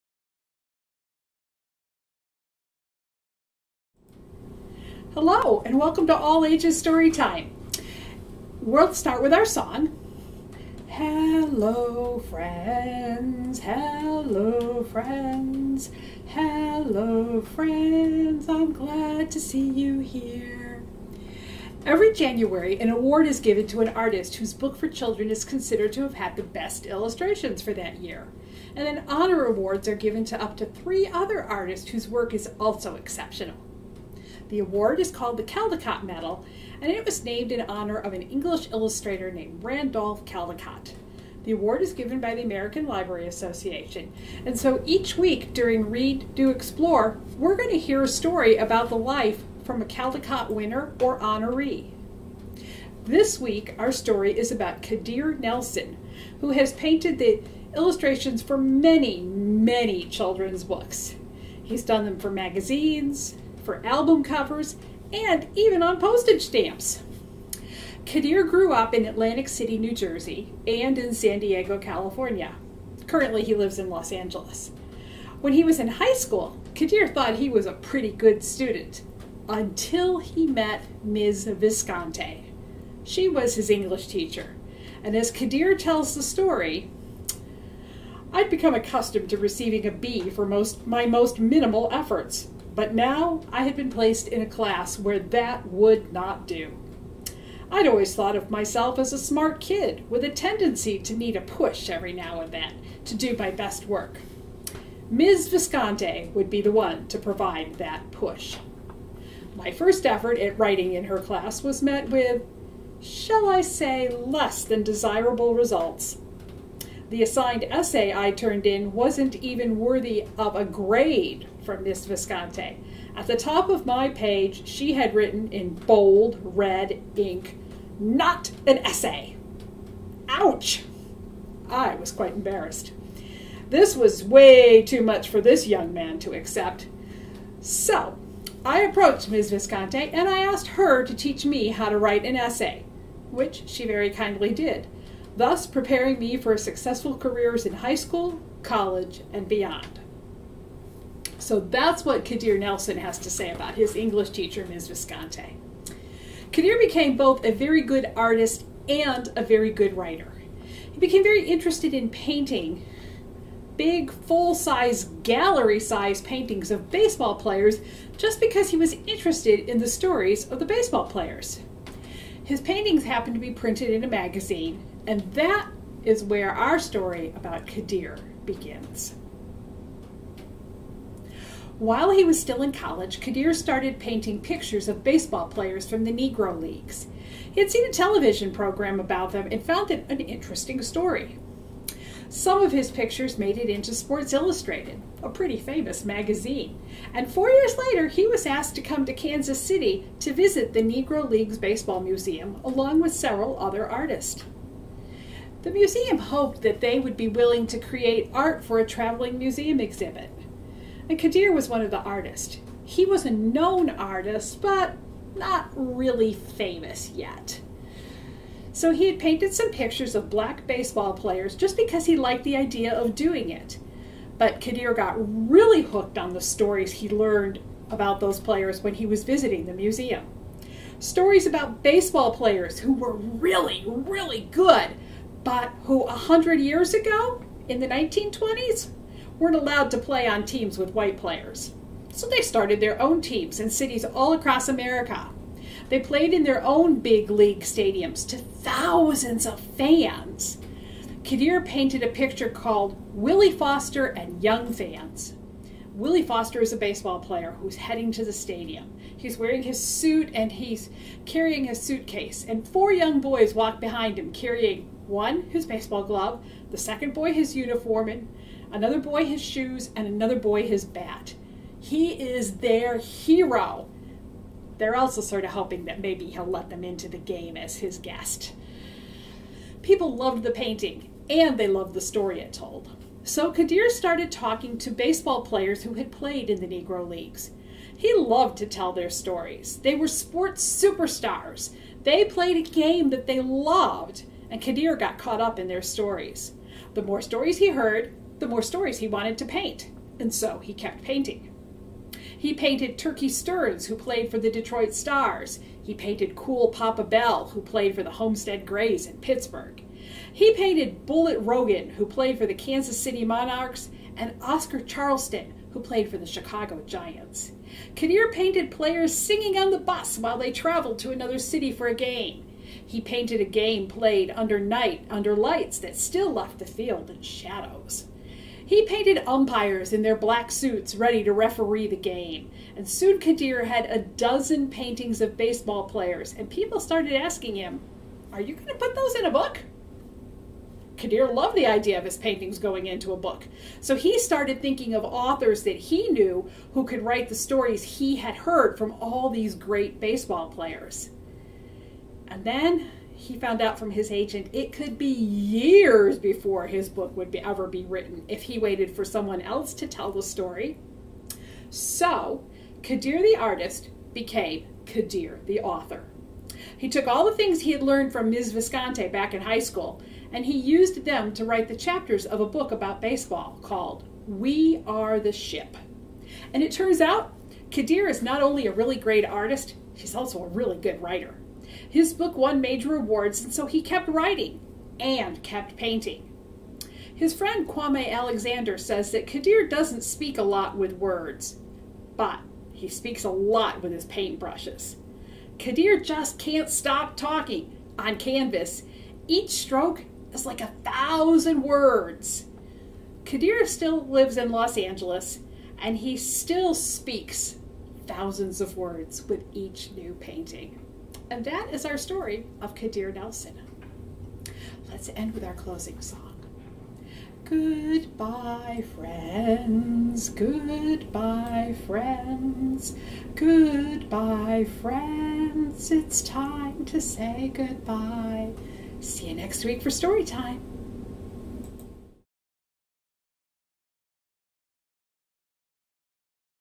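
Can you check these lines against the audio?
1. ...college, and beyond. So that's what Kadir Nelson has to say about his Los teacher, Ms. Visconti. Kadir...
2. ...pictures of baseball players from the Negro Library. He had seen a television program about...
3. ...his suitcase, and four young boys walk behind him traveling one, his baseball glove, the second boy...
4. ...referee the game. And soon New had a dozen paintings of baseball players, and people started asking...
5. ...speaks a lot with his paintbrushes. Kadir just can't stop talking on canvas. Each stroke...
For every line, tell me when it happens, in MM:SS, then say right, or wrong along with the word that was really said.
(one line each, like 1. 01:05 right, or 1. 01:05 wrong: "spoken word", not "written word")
1. 02:28 wrong: "English", not "Los"
2. 03:04 wrong: "Leagues", not "Library"
3. 04:21 wrong: "carrying", not "traveling"
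4. 05:31 wrong: "Kadir", not "New"
5. 06:32 right.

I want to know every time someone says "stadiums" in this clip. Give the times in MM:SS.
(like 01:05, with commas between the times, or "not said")
04:07, 04:18.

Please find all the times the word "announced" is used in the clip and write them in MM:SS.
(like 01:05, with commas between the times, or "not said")
not said.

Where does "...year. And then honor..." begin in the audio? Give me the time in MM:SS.
00:27.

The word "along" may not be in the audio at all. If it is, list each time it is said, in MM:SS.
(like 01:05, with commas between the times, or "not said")
03:22.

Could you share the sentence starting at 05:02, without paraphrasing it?
He painted Turkey Stearnes, who played for the Detroit Stars.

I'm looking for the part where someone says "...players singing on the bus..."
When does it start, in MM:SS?
05:18.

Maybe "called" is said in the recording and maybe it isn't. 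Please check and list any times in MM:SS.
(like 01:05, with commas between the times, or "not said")
00:35, 04:12, 06:13.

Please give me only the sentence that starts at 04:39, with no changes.
People loved the painting, and they loved the story it told.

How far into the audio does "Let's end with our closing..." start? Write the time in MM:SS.
06:54.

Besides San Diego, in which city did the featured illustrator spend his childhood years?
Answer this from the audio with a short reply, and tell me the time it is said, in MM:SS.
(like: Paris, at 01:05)
Atlantic City, at 01:09.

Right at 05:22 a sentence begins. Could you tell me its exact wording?
He painted a game played under night, under lights that still left the field in shadows.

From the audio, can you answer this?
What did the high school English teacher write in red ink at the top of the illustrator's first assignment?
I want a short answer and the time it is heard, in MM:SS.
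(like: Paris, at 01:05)
Not an essay, at 02:07.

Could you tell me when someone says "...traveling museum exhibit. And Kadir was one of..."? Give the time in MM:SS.
03:28.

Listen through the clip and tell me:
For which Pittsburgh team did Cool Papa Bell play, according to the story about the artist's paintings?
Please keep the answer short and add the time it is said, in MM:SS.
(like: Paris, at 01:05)
Homestead Grays, at 05:08.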